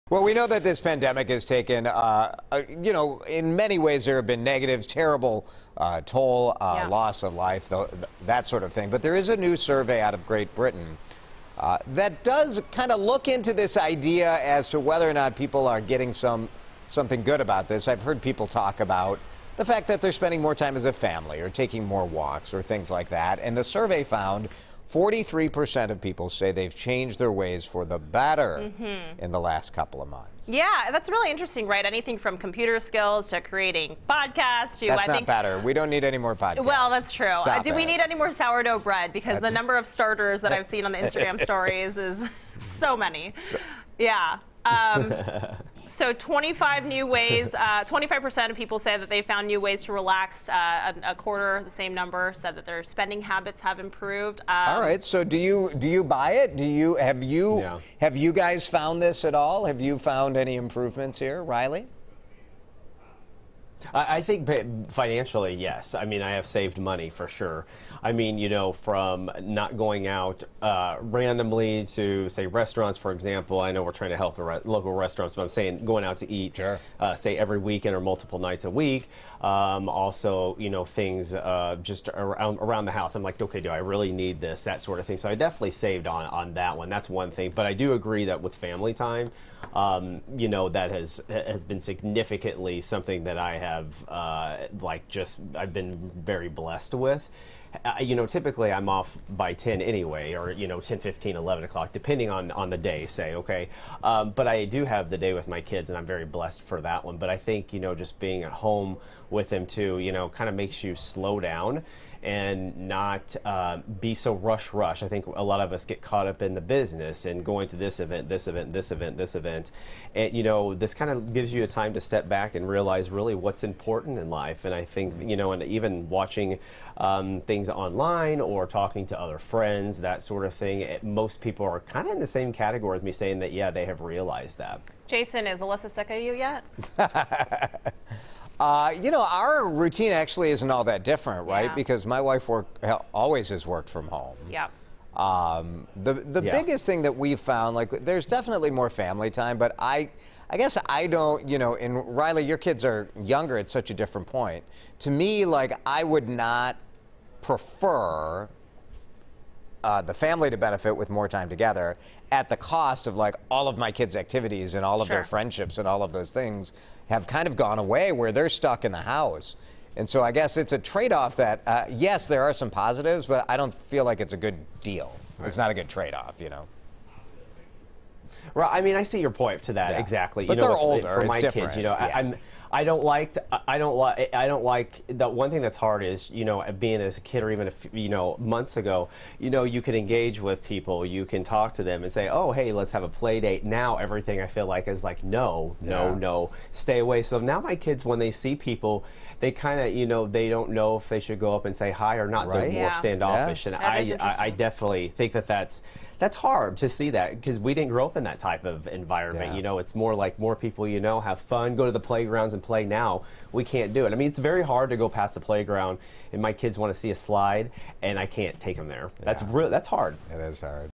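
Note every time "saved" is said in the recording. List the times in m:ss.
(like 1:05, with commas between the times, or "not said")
1:06, 1:25.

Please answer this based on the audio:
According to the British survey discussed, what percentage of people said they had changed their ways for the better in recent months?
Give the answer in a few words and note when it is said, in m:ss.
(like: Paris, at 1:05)
43%, at 0:24.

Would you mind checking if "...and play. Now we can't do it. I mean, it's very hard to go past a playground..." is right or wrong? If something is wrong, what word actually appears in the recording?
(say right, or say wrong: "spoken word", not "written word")
right.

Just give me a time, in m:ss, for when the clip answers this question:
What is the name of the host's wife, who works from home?
2:15.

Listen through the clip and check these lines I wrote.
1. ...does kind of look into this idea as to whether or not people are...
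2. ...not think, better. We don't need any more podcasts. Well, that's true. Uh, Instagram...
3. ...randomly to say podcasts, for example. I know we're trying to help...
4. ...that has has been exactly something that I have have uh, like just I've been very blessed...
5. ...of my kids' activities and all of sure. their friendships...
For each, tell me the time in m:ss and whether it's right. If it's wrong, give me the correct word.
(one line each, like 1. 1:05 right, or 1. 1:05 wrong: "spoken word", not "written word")
1. 0:12 right
2. 0:35 wrong: "Stop", not "Instagram"
3. 1:11 wrong: "restaurants", not "podcasts"
4. 1:30 wrong: "significantly", not "exactly"
5. 2:43 right.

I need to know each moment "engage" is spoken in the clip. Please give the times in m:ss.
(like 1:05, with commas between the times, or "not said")
3:09.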